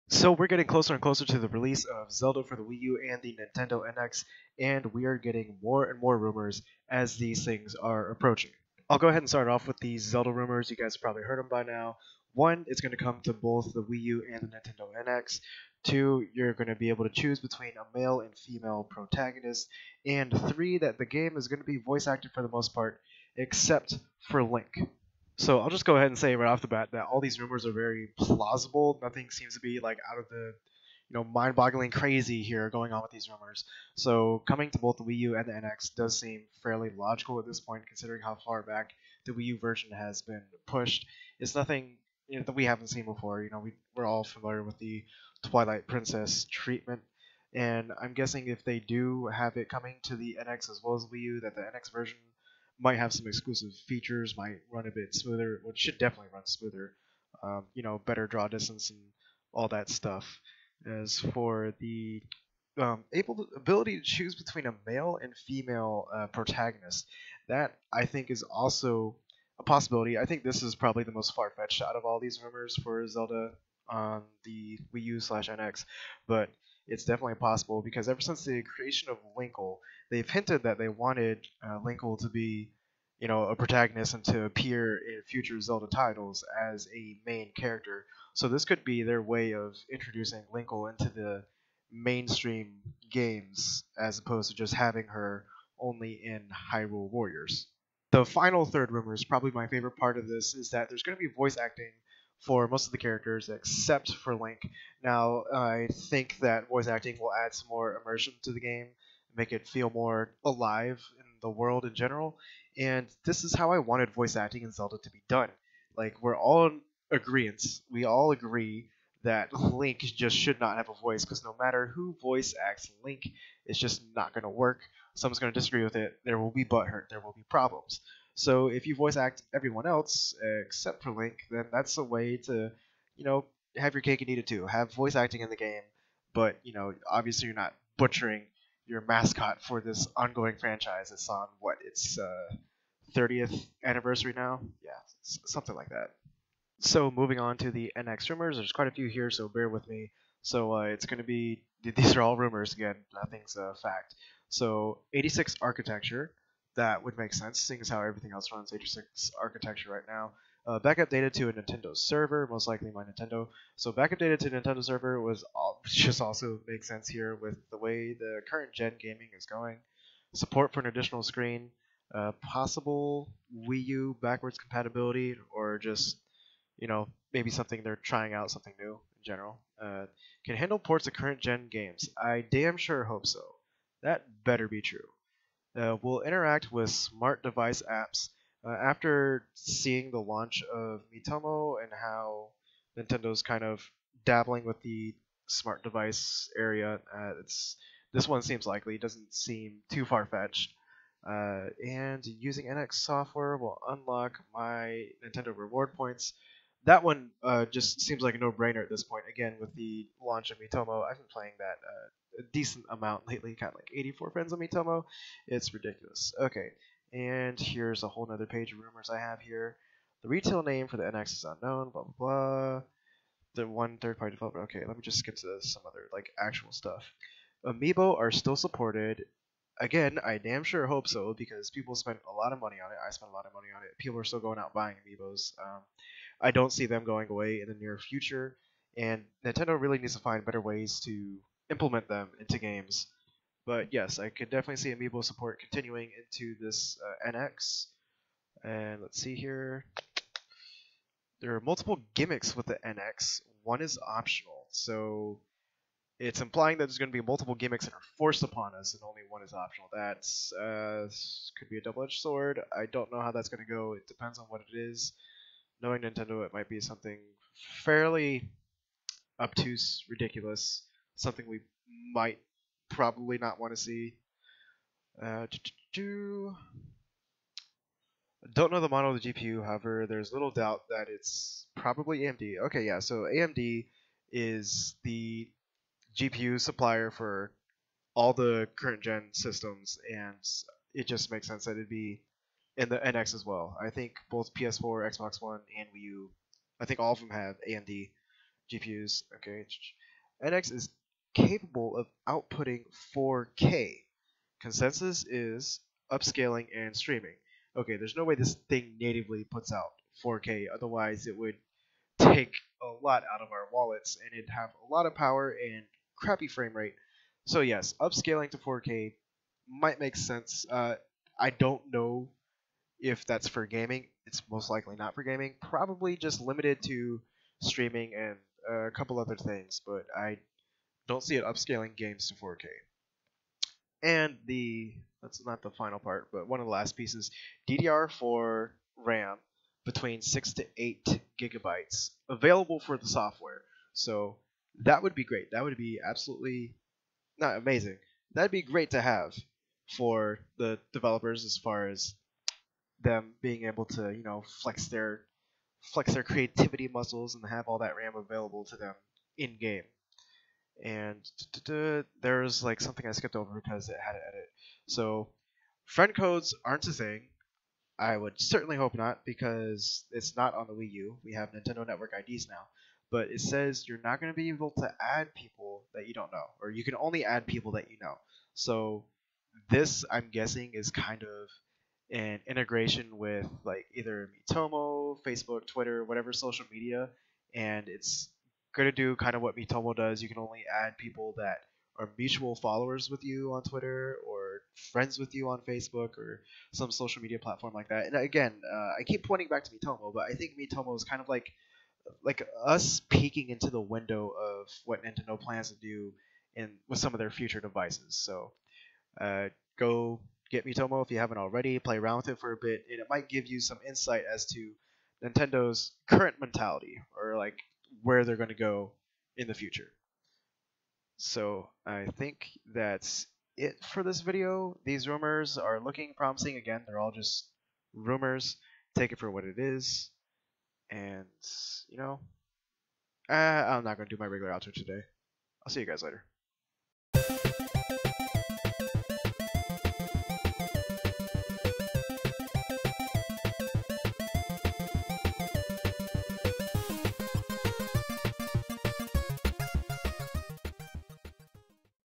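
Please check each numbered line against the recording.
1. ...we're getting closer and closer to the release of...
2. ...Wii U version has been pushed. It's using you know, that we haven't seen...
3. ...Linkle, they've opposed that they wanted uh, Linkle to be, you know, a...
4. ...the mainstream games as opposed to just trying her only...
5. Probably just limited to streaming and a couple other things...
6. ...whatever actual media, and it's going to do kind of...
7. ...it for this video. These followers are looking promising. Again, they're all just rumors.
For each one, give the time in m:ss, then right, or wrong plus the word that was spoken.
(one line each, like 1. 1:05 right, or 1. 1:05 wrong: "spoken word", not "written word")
1. 0:00 right
2. 0:39 wrong: "nothing", not "using"
3. 1:19 wrong: "hinted", not "opposed"
4. 1:31 wrong: "having", not "trying"
5. 5:25 right
6. 6:26 wrong: "social", not "actual"
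7. 7:03 wrong: "rumors", not "followers".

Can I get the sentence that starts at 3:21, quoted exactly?
Uh, and using NX software will unlock my Nintendo reward points that one uh, just seems like a no-brainer at this point.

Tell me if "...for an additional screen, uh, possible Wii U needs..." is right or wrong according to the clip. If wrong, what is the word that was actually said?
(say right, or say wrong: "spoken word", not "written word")
wrong: "backwards", not "needs".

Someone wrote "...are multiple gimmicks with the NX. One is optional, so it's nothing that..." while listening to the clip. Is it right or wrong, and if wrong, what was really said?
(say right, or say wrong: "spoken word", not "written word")
wrong: "implying", not "nothing".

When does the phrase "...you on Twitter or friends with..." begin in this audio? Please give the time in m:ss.
6:33.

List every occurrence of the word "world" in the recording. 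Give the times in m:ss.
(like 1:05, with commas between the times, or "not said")
1:51.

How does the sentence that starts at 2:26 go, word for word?
So moving on to the NX rumors, there's quite a few here, so bear with me.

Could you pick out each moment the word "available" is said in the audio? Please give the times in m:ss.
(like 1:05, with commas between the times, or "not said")
5:42, 5:58.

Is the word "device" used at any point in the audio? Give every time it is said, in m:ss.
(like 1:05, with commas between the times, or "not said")
3:07, 3:15, 6:47.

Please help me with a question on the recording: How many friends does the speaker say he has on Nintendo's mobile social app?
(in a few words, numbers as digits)
84.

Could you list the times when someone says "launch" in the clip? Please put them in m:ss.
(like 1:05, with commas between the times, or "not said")
3:10, 3:30.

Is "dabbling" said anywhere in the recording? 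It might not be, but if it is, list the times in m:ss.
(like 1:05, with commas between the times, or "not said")
3:14.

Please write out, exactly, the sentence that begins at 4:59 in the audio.
Okay, NX is capable of outputting 4K.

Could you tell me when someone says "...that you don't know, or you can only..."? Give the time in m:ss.
6:15.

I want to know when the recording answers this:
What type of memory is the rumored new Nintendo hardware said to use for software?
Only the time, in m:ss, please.
5:37.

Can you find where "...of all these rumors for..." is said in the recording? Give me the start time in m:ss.
1:11.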